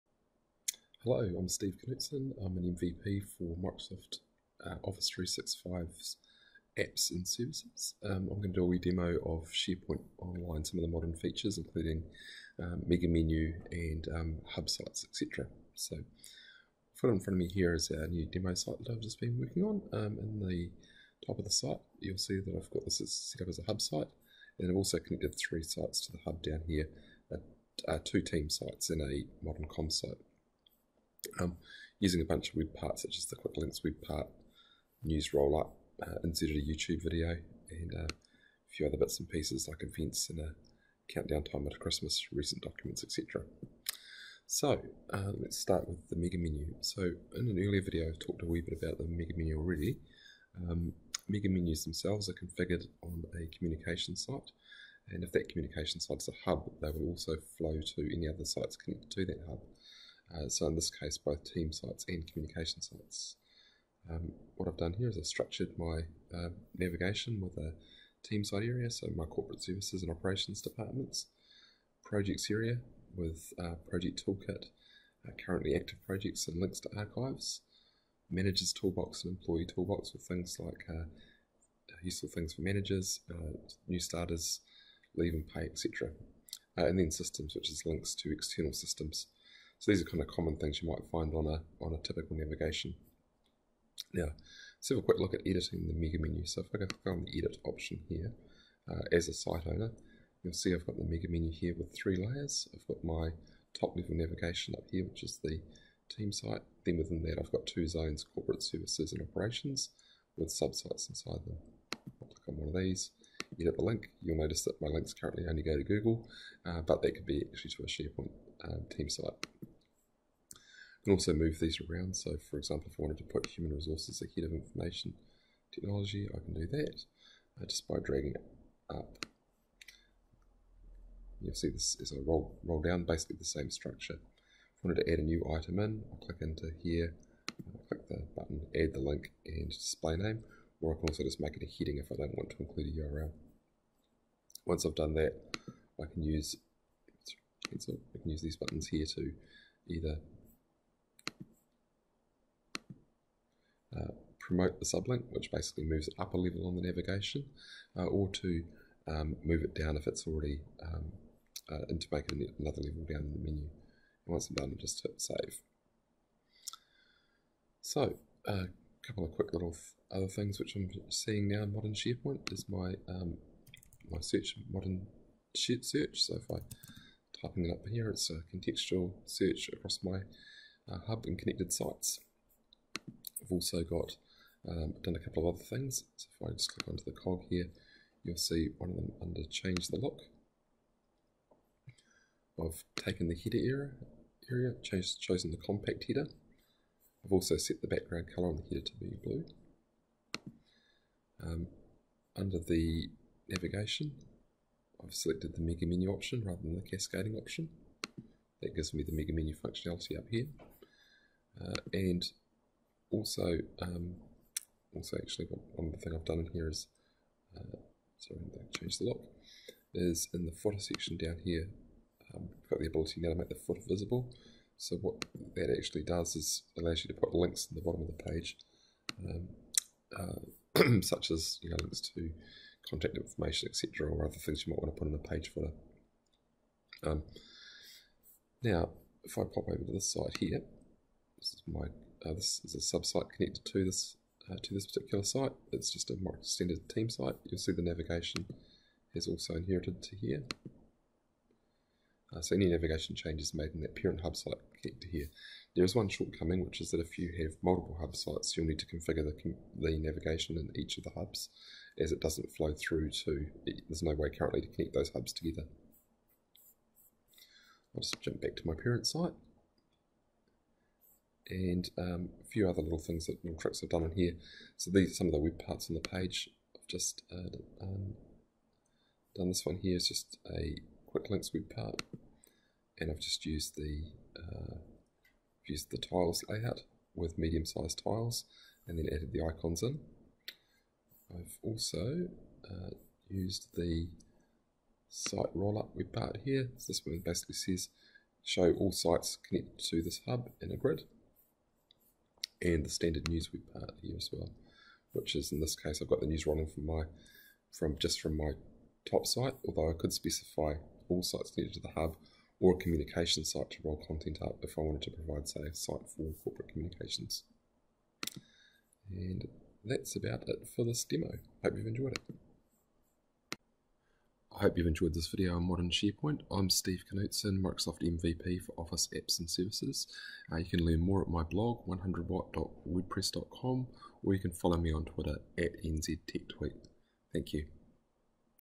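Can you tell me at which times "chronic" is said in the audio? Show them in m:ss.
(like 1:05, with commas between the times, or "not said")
not said.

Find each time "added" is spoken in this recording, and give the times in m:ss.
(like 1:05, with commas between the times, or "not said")
4:49.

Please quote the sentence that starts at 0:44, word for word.
So uh, let's start with the mega menu.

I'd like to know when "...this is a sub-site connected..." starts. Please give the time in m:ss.
4:02.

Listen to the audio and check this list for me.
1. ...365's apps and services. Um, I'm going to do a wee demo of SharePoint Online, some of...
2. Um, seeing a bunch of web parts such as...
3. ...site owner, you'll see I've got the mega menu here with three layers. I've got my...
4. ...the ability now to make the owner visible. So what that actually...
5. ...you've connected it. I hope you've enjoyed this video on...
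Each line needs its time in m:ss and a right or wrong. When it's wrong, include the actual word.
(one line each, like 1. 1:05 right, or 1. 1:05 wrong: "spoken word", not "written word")
1. 0:05 right
2. 0:31 wrong: "using", not "seeing"
3. 1:39 right
4. 3:42 wrong: "footer", not "owner"
5. 5:21 wrong: "enjoyed", not "connected".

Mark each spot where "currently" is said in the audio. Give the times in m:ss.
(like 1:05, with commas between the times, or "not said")
1:15, 1:55, 4:24.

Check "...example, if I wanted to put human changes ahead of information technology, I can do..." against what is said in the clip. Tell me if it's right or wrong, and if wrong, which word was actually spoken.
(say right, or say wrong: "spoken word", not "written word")
wrong: "resources", not "changes".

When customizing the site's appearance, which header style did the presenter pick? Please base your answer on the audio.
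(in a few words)
compact header.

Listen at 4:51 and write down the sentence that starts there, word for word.
I've also uh, used the site rollup web part here.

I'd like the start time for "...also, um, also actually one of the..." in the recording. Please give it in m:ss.
3:33.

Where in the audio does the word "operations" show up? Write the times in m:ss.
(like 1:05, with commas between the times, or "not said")
1:10, 1:49.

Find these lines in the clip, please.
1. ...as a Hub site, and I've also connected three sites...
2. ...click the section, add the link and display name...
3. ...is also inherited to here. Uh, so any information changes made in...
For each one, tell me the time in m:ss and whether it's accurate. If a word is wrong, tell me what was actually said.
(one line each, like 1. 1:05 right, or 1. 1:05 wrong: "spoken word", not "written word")
1. 0:23 right
2. 2:17 wrong: "button", not "section"
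3. 4:09 wrong: "navigation", not "information".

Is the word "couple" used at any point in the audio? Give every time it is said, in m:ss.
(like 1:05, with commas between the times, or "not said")
2:49, 3:05.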